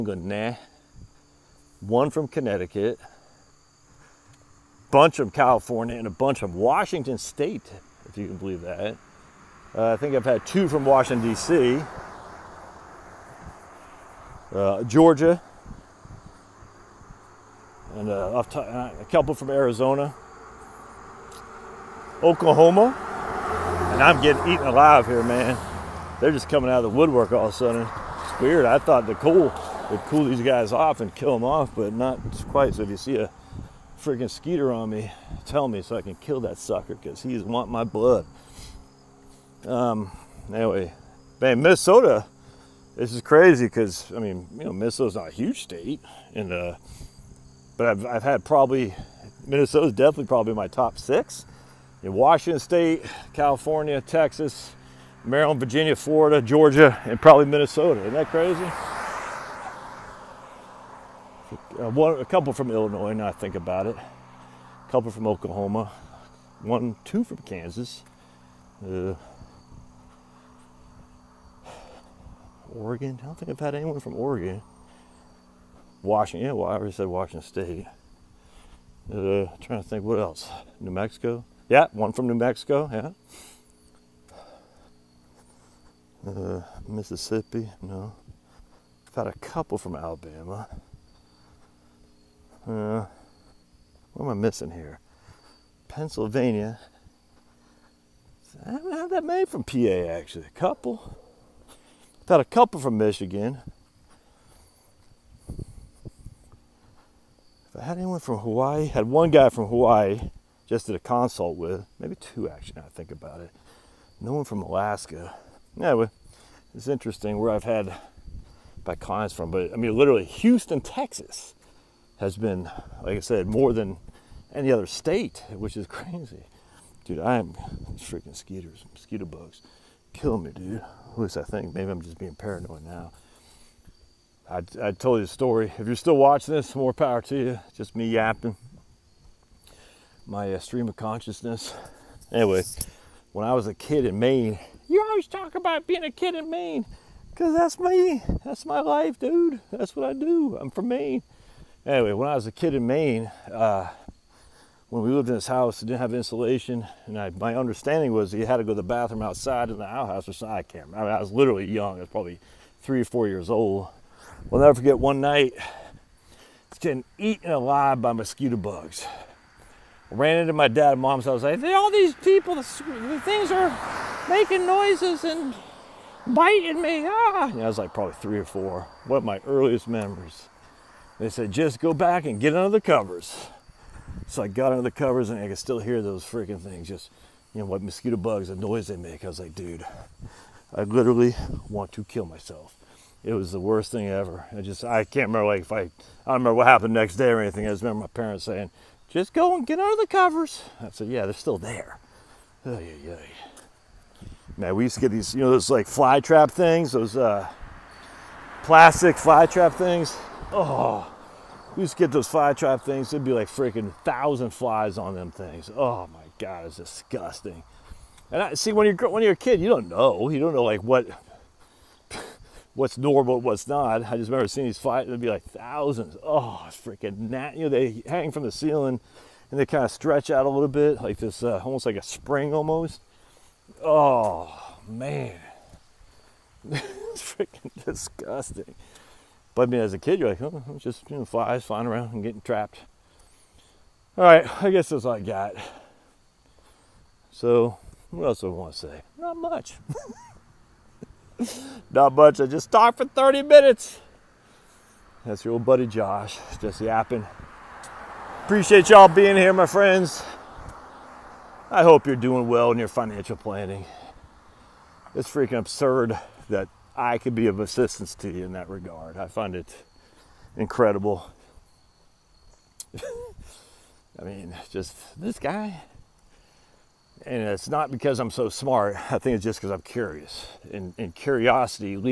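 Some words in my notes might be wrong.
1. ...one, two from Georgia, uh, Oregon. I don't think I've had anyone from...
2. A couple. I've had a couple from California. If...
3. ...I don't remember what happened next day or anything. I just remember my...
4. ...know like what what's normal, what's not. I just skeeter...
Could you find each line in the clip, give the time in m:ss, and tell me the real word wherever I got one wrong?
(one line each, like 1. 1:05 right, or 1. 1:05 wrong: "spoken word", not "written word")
1. 1:06 wrong: "Kansas", not "Georgia"
2. 1:40 wrong: "Michigan", not "California"
3. 3:15 right
4. 3:40 wrong: "remember", not "skeeter".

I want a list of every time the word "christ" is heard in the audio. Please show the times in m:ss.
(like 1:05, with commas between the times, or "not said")
not said.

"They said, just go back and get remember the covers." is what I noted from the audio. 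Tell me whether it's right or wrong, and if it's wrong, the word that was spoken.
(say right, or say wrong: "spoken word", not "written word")
wrong: "under", not "remember".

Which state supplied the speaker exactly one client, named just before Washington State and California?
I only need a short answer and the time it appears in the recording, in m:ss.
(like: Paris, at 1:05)
Connecticut, at 0:02.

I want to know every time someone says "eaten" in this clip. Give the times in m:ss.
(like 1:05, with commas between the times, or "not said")
0:24, 2:47.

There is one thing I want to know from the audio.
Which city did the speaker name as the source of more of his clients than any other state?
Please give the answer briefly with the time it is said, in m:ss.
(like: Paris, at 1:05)
Houston, Texas, at 2:00.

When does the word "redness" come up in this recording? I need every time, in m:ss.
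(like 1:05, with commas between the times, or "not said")
not said.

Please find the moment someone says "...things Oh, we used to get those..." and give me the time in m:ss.
3:29.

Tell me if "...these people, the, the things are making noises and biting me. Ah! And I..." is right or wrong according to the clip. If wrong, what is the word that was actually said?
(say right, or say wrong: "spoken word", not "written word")
right.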